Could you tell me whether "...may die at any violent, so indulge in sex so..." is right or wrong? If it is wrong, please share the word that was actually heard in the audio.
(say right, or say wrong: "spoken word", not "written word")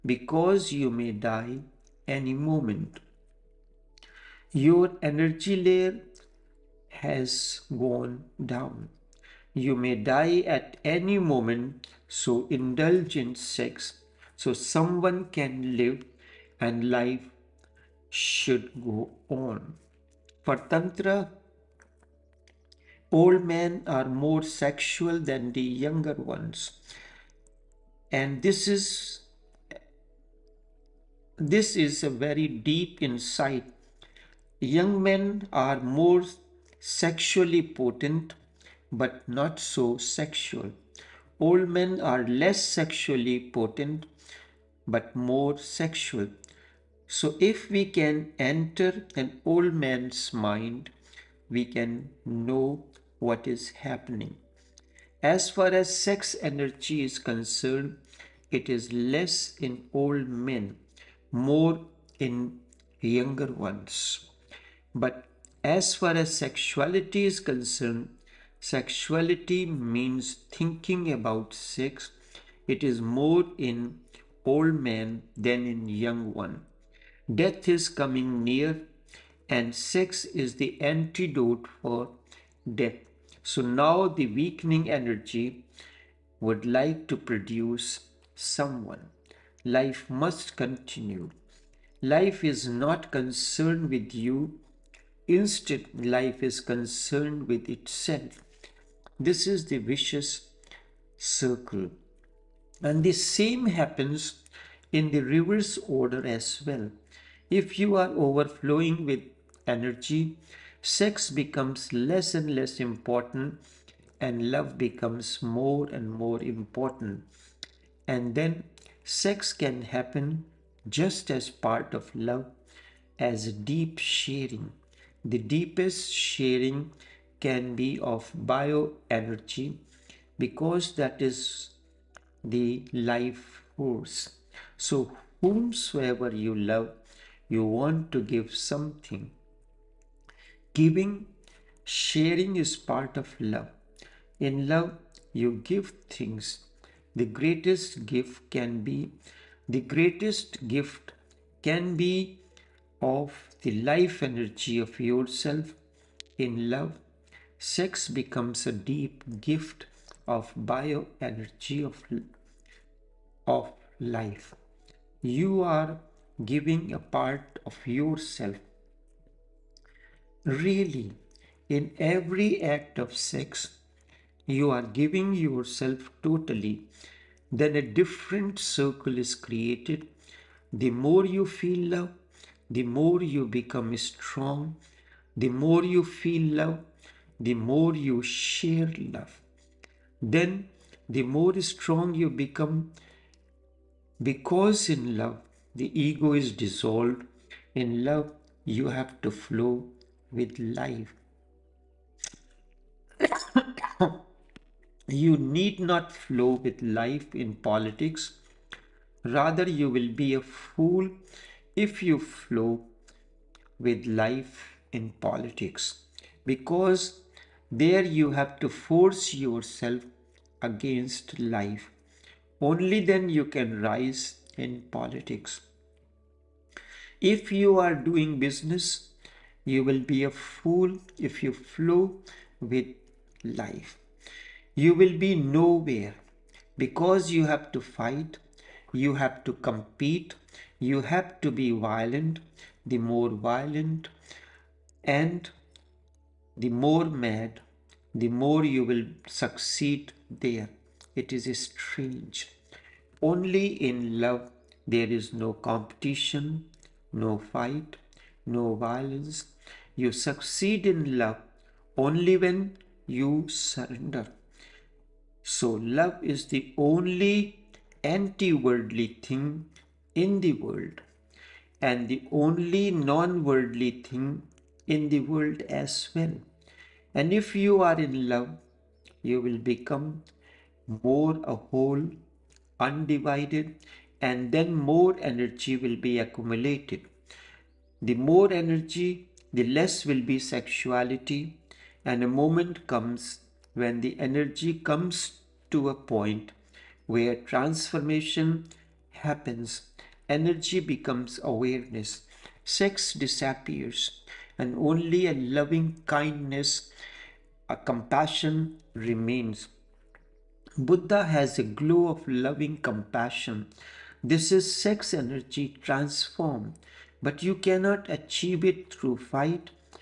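wrong: "moment", not "violent".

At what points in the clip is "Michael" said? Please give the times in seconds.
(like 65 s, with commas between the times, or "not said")
not said.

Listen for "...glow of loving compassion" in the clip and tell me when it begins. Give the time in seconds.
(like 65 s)
311 s.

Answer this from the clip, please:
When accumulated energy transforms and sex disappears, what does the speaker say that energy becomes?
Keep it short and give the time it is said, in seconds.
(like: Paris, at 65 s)
Awareness, at 300 s.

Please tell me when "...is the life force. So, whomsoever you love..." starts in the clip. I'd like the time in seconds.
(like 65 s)
131 s.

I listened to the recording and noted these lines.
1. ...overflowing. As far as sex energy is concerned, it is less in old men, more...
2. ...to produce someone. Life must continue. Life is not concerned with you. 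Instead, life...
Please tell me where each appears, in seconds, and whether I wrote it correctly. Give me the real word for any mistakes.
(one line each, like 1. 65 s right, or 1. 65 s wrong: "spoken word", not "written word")
1. 53 s wrong: "happening", not "overflowing"
2. 87 s right.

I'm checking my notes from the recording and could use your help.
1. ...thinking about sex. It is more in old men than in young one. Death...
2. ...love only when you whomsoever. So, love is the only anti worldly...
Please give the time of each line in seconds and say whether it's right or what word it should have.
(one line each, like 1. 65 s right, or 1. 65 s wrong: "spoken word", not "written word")
1. 70 s right
2. 261 s wrong: "surrender", not "whomsoever".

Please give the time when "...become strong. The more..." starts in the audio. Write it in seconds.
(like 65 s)
183 s.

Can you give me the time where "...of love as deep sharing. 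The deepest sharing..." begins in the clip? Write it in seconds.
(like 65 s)
121 s.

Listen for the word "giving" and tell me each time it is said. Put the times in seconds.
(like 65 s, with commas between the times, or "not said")
140 s, 166 s, 174 s.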